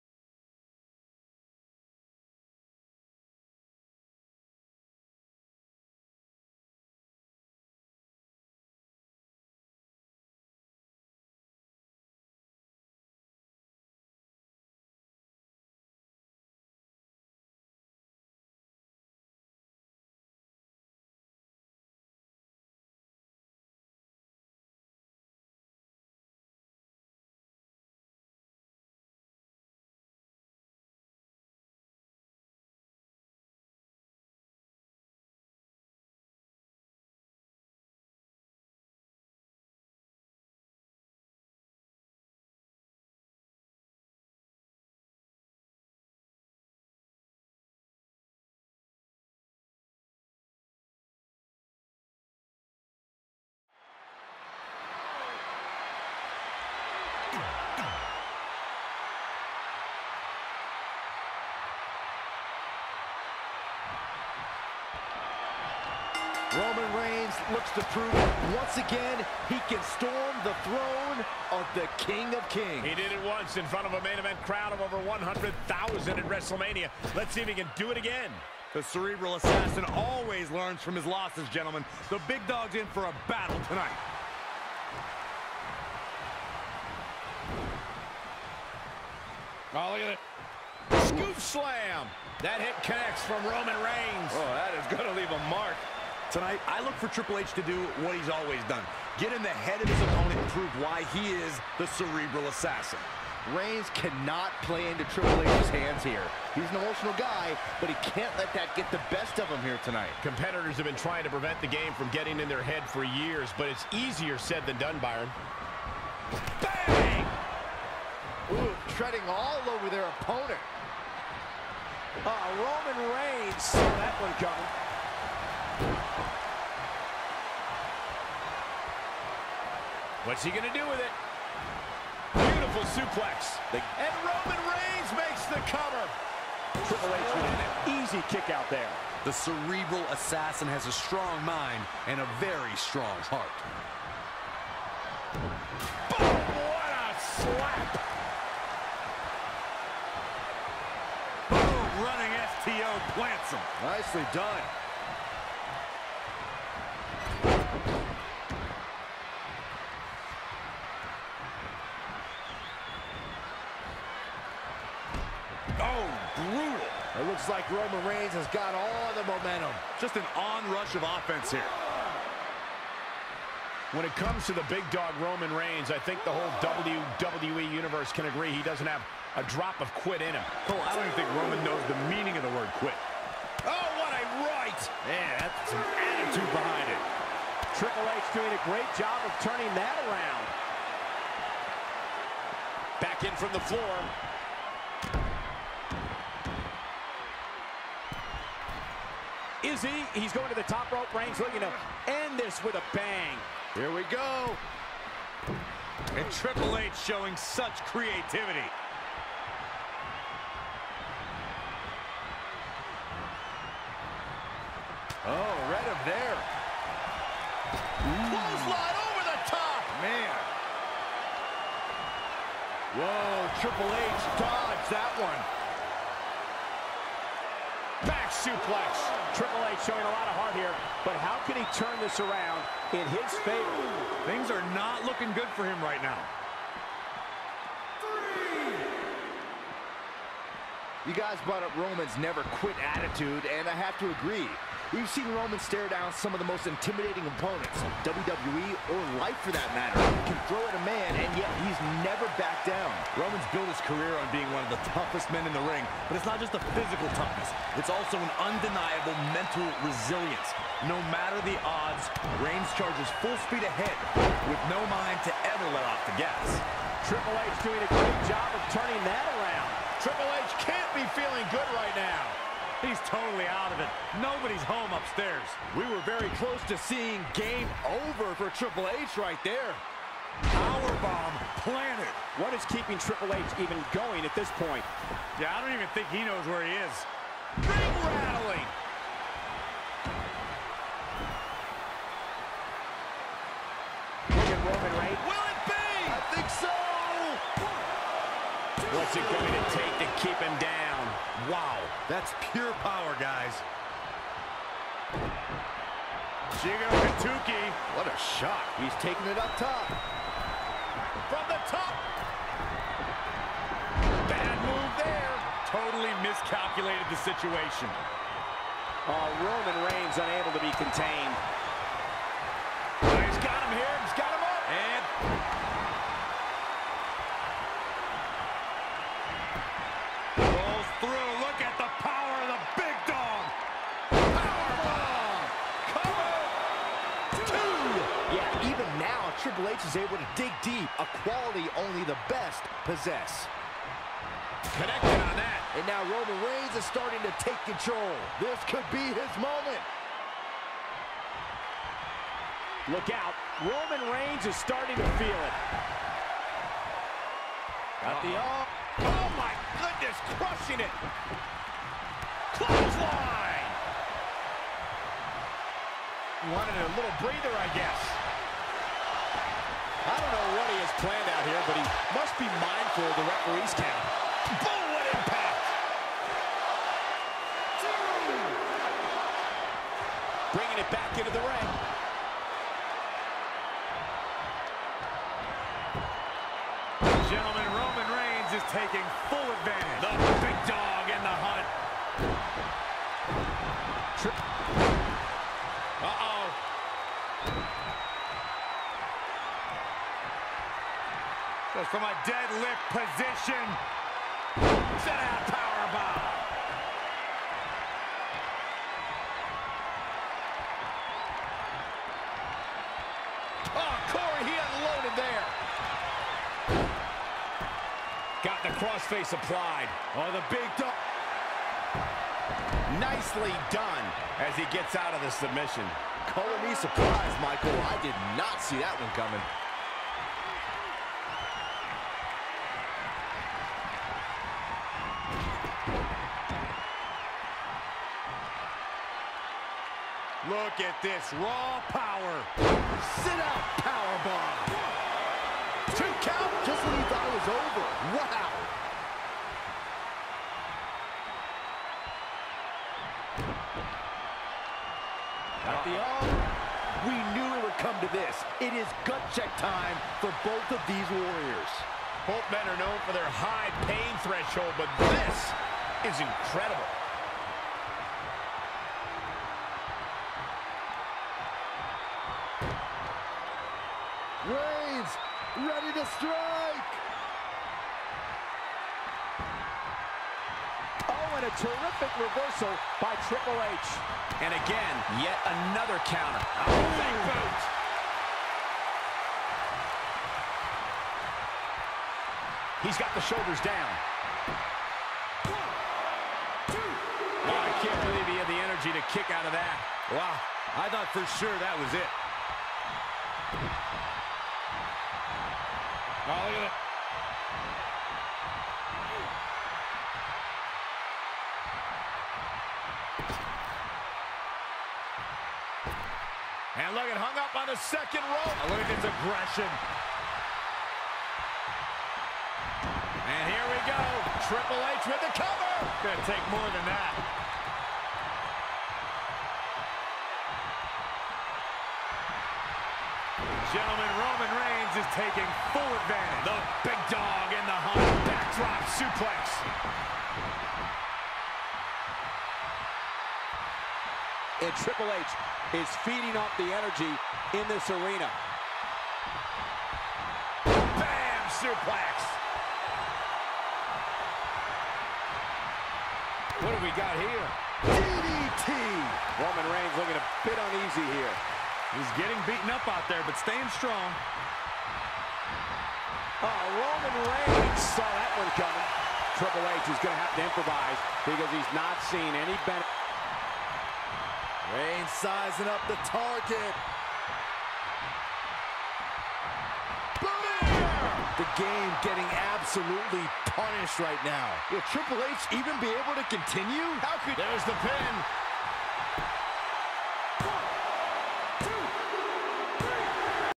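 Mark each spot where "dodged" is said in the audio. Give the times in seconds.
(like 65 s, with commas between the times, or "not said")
224 s.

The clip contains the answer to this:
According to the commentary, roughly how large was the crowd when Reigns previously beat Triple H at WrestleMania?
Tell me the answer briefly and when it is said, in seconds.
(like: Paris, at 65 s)
over 100,000, at 74 s.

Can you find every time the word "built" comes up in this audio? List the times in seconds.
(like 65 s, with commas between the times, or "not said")
253 s.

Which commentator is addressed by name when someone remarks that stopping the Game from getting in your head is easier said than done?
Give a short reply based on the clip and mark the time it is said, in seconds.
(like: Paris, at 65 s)
Byron, at 114 s.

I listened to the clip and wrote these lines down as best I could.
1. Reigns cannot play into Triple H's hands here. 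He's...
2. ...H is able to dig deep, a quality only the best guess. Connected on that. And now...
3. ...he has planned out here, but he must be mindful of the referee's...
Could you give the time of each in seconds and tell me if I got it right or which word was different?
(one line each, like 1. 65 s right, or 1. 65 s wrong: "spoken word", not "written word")
1. 103 s right
2. 339 s wrong: "possess", not "guess"
3. 370 s right.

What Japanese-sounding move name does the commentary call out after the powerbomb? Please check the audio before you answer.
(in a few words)
Jigo Katuki.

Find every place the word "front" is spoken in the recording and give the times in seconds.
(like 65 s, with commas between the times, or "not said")
73 s.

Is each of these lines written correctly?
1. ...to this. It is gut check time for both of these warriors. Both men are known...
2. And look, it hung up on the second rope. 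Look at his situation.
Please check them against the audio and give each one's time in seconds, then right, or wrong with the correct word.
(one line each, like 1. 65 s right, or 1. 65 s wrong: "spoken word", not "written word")
1. 458 s right
2. 516 s wrong: "aggression", not "situation".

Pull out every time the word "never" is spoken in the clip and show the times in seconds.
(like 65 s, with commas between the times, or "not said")
242 s, 252 s.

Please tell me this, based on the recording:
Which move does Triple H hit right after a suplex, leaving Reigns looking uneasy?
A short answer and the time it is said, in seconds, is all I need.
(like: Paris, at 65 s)
DDT, at 557 s.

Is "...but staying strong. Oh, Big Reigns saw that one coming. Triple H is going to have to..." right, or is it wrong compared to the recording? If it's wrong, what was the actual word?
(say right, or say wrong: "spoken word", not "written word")
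wrong: "Roman", not "Big".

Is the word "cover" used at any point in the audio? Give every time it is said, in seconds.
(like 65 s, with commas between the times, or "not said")
135 s, 525 s.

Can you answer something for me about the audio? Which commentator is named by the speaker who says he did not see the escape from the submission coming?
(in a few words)
Michael.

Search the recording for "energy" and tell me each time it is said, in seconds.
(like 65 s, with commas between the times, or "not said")
498 s, 546 s.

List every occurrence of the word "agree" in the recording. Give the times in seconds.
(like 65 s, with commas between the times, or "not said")
178 s, 244 s.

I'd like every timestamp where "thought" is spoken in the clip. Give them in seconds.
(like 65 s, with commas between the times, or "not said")
447 s, 500 s.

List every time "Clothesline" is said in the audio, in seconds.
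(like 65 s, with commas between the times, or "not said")
217 s, 362 s.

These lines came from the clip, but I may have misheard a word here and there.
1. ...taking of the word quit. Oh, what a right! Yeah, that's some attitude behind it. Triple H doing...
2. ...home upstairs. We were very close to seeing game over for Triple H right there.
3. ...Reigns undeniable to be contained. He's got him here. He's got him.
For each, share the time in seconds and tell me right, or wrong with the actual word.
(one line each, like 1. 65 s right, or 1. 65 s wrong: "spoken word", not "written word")
1. 182 s wrong: "meaning", not "taking"
2. 274 s right
3. 319 s wrong: "unable", not "undeniable".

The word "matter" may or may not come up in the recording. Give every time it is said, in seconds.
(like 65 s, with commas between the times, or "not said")
249 s, 261 s.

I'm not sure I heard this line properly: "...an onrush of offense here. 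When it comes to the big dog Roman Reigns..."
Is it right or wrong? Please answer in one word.
right.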